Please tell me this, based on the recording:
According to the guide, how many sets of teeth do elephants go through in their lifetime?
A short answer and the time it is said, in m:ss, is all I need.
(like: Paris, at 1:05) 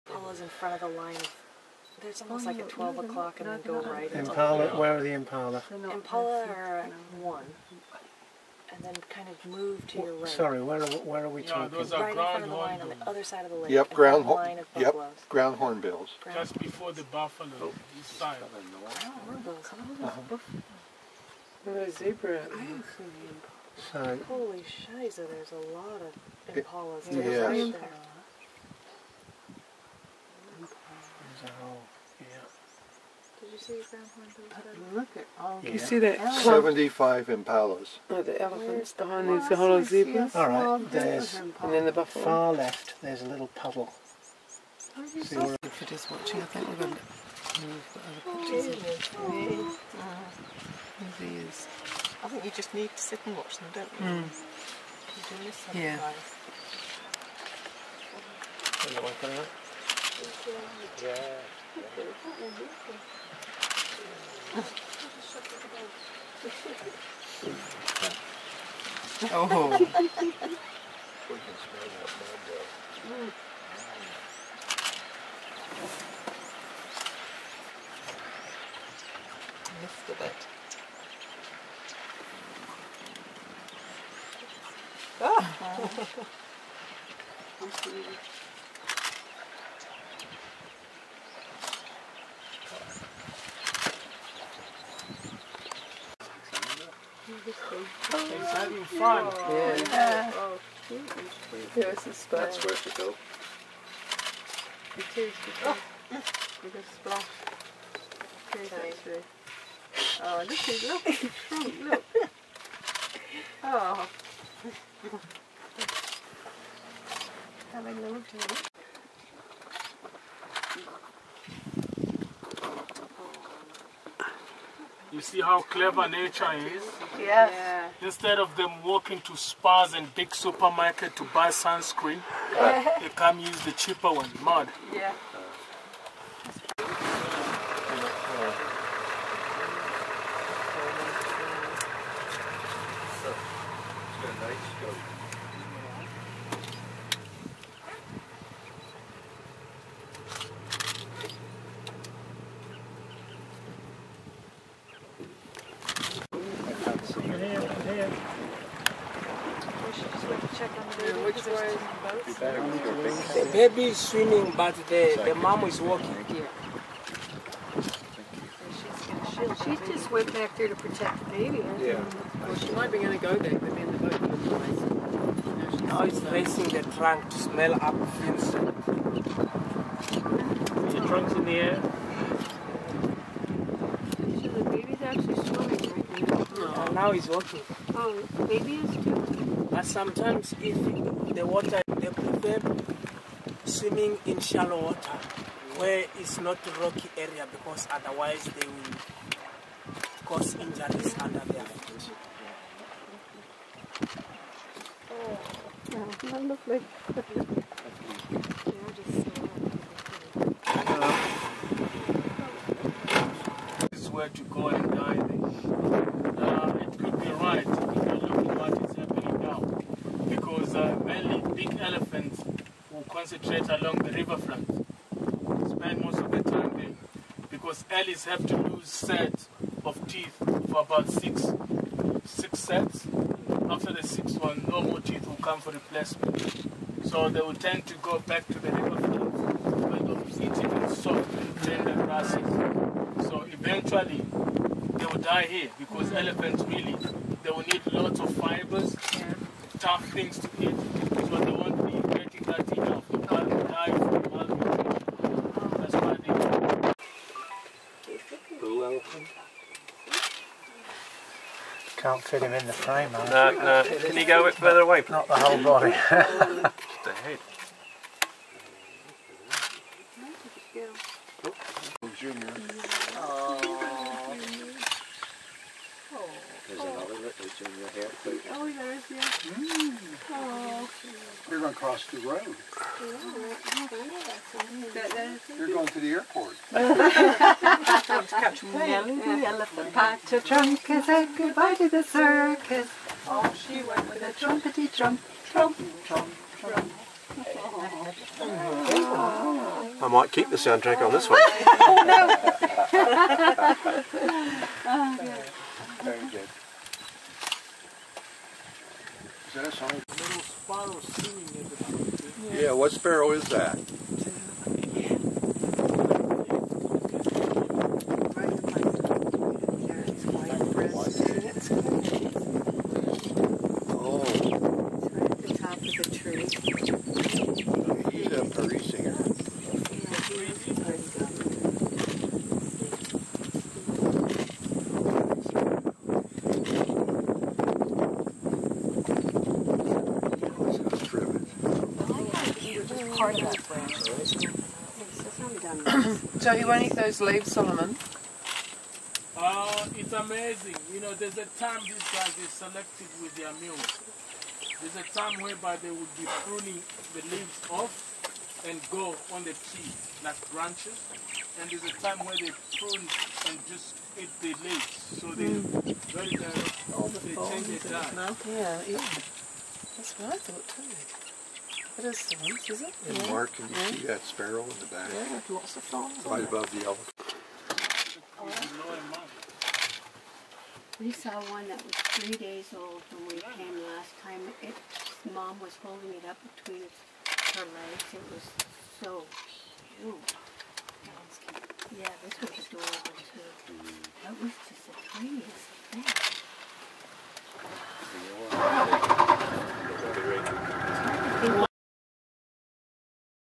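6, at 3:52.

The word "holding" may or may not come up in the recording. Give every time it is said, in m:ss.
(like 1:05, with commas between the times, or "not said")
6:25.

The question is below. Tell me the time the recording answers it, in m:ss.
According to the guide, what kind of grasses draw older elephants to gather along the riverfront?
4:00.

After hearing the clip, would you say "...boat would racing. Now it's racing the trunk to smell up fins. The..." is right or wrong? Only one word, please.
right.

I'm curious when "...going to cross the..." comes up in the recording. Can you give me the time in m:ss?
4:41.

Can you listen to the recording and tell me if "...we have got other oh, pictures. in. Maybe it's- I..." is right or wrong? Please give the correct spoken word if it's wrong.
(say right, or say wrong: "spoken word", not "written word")
right.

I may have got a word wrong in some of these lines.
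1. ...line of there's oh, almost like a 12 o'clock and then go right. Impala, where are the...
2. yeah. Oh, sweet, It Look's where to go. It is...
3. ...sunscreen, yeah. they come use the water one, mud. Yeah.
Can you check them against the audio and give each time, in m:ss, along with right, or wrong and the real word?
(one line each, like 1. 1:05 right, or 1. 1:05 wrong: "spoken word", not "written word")
1. 0:00 right
2. 1:39 wrong: "That", not "Look"
3. 2:11 wrong: "cheaper", not "water".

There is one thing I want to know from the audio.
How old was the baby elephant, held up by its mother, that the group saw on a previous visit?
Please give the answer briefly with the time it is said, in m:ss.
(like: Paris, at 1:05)
3 days old, at 6:22.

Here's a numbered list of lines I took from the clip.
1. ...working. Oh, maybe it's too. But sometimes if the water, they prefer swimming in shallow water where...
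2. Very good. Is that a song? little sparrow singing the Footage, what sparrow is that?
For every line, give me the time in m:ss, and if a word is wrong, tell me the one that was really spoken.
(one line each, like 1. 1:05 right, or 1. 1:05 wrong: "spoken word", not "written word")
1. 3:07 right
2. 5:06 wrong: "Yeah", not "Footage".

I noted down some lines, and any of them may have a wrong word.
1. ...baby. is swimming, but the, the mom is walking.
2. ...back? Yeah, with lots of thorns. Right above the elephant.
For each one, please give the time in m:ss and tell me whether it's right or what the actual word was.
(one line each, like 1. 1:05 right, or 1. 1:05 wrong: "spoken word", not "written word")
1. 2:43 right
2. 6:14 right.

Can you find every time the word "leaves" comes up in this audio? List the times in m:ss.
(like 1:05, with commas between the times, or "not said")
5:47, 5:57, 6:04.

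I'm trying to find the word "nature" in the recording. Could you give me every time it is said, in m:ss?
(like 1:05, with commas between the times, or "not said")
2:06.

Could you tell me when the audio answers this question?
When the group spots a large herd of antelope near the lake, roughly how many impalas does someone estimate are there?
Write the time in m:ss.
0:36.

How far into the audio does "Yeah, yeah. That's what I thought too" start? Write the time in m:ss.
6:08.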